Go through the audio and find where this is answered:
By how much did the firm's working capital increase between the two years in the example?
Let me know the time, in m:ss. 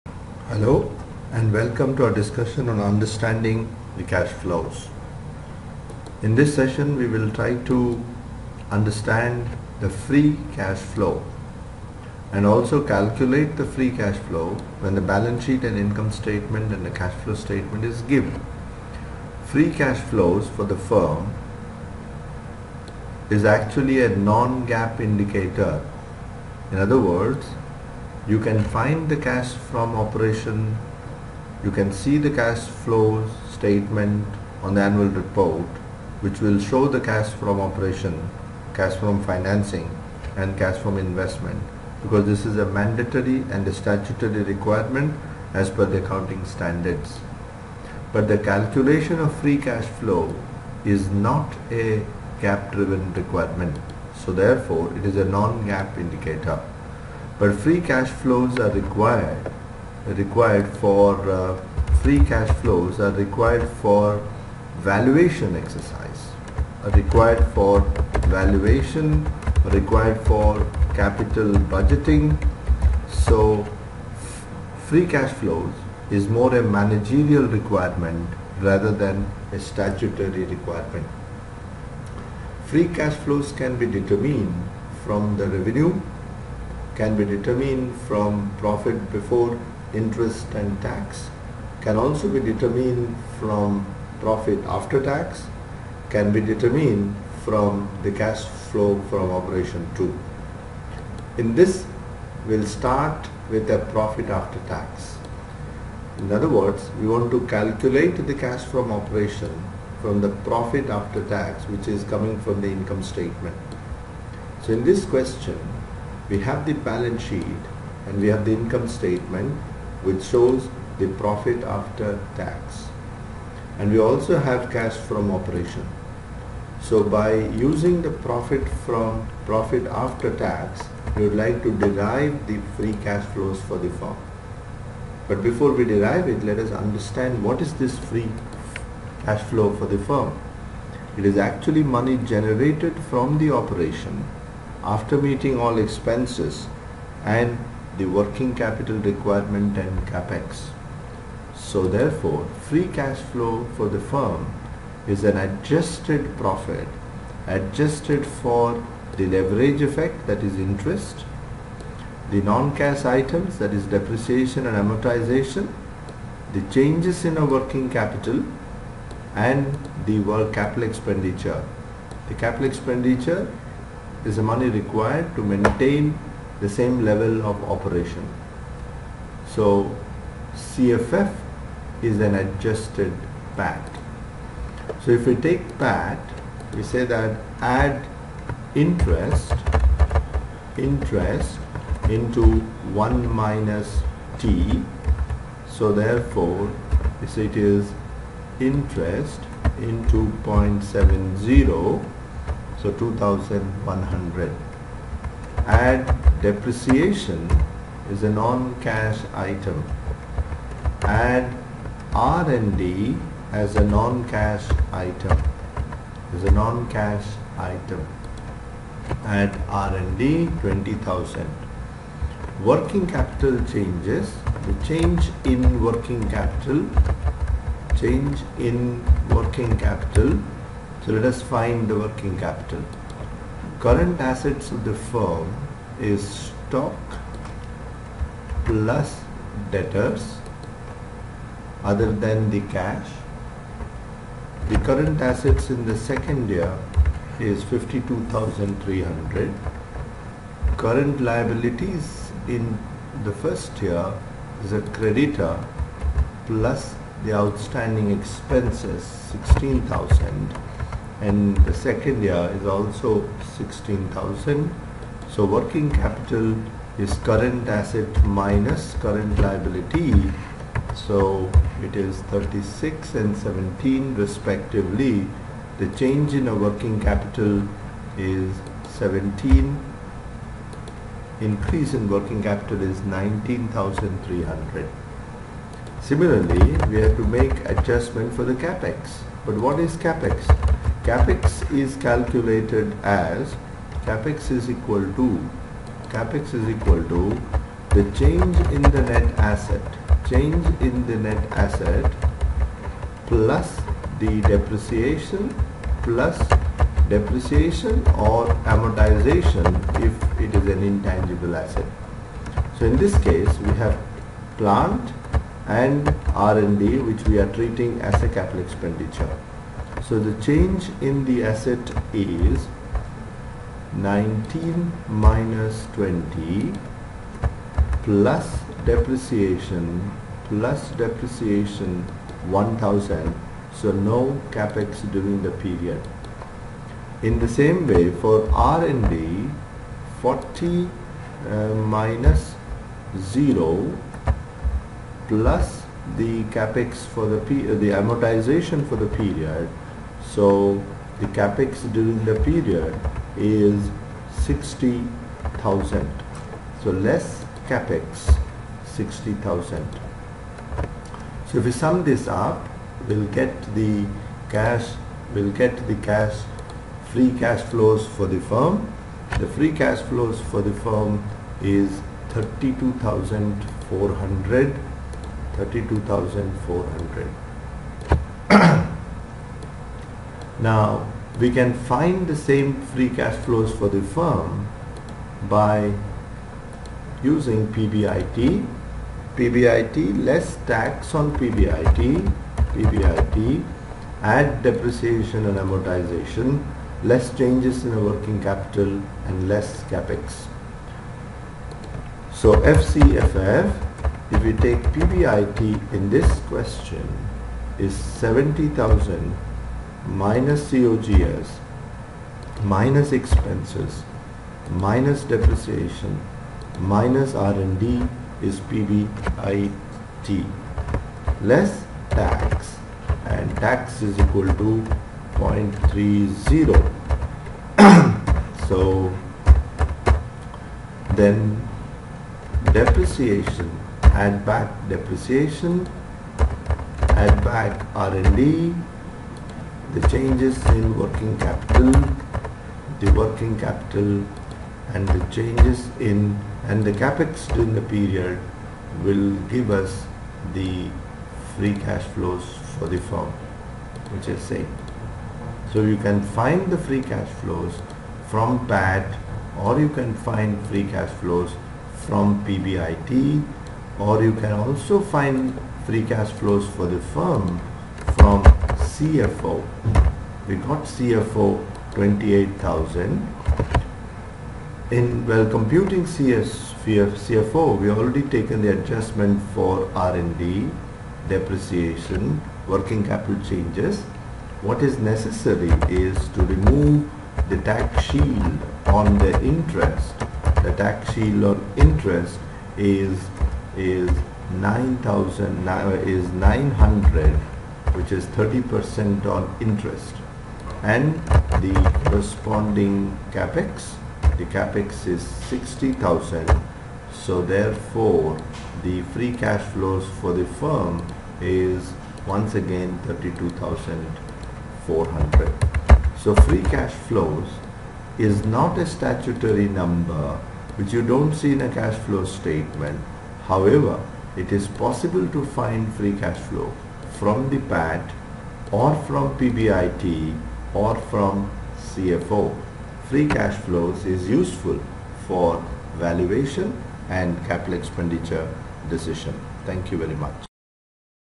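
4:43.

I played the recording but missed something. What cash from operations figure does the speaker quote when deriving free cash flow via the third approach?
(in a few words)
28,000.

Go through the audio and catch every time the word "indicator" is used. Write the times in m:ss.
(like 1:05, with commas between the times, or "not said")
0:24, 0:55.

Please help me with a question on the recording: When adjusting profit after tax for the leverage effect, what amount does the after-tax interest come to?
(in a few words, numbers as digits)
2100.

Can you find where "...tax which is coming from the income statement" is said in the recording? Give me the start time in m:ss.
1:51.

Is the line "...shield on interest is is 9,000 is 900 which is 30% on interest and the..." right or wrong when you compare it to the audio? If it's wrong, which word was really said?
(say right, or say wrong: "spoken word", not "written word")
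right.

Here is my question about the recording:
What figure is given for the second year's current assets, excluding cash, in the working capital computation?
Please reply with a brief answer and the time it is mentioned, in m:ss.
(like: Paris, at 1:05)
52,300, at 4:07.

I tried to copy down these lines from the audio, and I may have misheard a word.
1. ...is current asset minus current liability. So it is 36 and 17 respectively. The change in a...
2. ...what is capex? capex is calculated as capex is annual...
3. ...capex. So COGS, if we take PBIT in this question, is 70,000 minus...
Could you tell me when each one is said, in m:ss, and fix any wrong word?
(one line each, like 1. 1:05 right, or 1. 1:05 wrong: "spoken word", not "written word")
1. 4:26 right
2. 4:49 wrong: "equal", not "annual"
3. 6:39 wrong: "FCFF", not "COGS".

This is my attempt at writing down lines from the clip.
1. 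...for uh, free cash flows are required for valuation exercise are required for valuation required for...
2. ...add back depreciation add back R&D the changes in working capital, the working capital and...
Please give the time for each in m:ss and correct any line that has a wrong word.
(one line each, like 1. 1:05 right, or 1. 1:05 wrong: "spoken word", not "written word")
1. 1:00 right
2. 7:14 right.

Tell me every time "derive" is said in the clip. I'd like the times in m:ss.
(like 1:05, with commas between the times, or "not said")
2:11, 2:15.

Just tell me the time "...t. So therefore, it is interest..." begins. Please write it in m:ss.
3:14.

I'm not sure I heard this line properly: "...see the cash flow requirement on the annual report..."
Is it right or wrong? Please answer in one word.
wrong.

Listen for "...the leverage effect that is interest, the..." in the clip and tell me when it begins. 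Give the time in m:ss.
2:39.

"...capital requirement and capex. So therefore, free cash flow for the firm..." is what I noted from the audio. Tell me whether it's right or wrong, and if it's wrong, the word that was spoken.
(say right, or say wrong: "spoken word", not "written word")
right.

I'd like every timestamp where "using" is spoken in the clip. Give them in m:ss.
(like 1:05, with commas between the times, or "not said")
2:07, 6:27.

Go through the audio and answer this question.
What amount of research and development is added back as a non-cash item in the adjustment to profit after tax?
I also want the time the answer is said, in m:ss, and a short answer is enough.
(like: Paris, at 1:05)
20,000, at 3:39.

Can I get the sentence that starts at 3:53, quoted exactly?
Current assets of the firm is stock plus debtors other than the cash.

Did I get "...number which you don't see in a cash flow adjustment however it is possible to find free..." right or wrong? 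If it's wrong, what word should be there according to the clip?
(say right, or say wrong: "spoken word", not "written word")
wrong: "statement", not "adjustment".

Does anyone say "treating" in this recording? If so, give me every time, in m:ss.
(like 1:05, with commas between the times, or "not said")
5:17.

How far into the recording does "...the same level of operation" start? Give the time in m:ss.
2:56.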